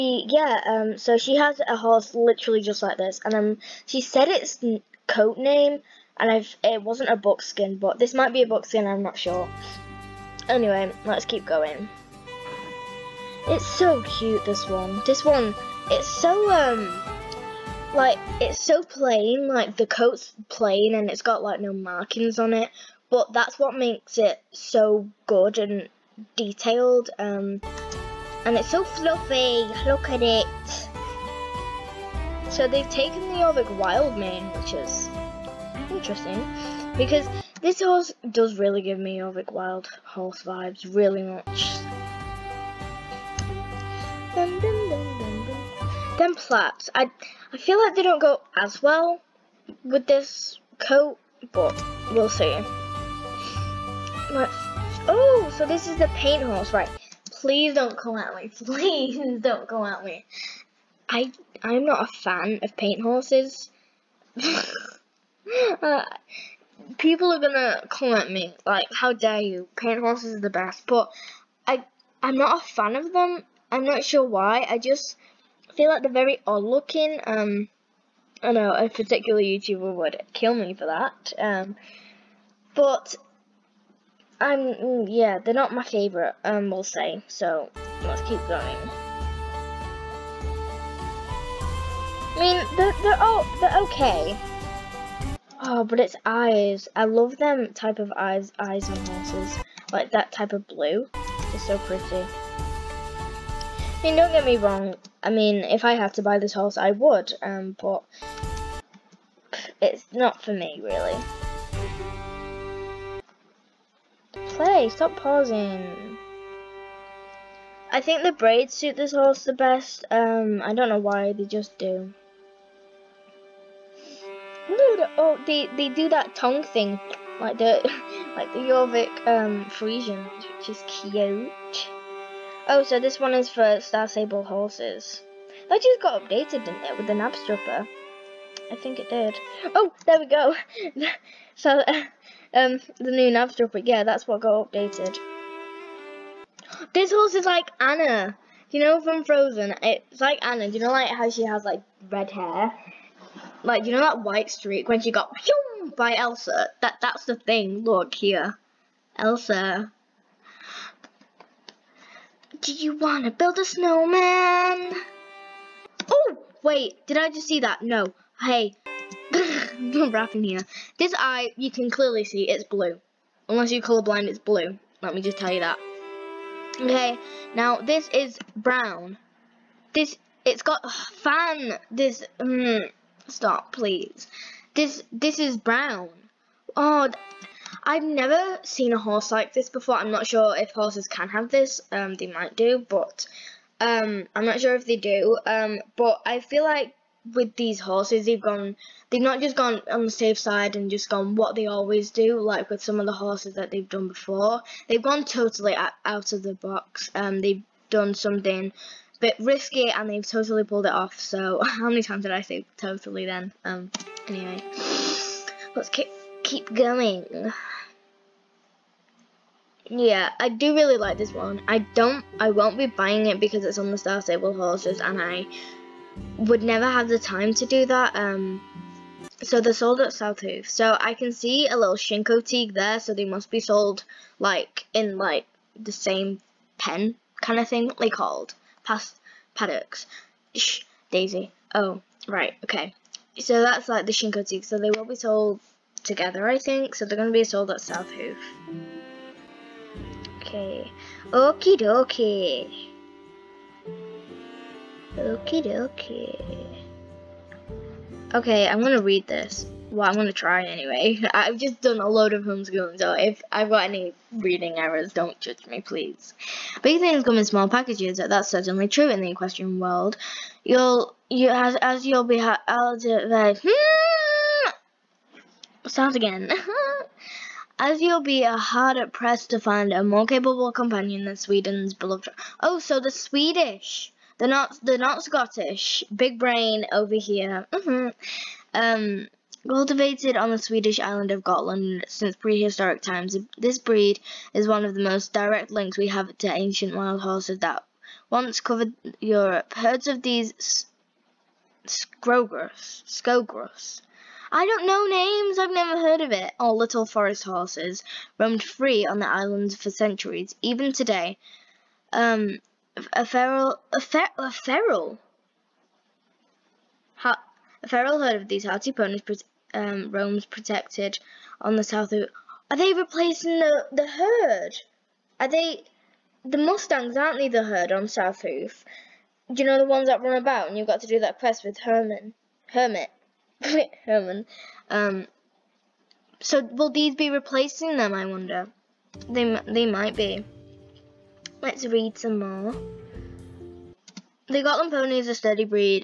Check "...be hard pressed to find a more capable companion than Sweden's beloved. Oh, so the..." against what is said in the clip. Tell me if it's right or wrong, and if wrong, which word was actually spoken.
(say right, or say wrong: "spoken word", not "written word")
right.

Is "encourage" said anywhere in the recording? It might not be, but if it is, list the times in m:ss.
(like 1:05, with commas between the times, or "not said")
not said.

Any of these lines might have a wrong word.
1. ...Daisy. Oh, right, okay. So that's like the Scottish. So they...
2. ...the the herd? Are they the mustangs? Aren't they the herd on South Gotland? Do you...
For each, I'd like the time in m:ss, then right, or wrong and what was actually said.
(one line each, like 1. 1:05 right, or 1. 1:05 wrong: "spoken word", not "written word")
1. 4:01 wrong: "Chincoteague", not "Scottish"
2. 5:23 wrong: "Hoof", not "Gotland".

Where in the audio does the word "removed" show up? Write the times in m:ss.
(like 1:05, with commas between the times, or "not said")
not said.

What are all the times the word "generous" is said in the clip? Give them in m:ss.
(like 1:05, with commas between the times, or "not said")
not said.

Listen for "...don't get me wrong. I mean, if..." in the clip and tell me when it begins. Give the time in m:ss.
1:44.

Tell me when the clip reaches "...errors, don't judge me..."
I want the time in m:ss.
4:24.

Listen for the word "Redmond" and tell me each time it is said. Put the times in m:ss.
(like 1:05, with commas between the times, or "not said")
not said.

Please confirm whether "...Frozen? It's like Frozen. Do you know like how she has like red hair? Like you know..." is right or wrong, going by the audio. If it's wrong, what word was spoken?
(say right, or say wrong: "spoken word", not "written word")
wrong: "Anna", not "Frozen".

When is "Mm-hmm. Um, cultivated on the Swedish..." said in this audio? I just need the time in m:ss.
4:47.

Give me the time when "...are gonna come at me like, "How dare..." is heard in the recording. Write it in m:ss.
1:07.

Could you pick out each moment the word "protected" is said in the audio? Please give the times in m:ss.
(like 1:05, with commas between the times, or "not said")
5:20.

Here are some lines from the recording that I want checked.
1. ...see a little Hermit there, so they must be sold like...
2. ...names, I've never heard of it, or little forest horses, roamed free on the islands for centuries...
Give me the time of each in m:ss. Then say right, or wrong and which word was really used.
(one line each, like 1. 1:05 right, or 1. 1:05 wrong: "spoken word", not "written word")
1. 3:51 wrong: "Chincoteague", not "Hermit"
2. 5:05 right.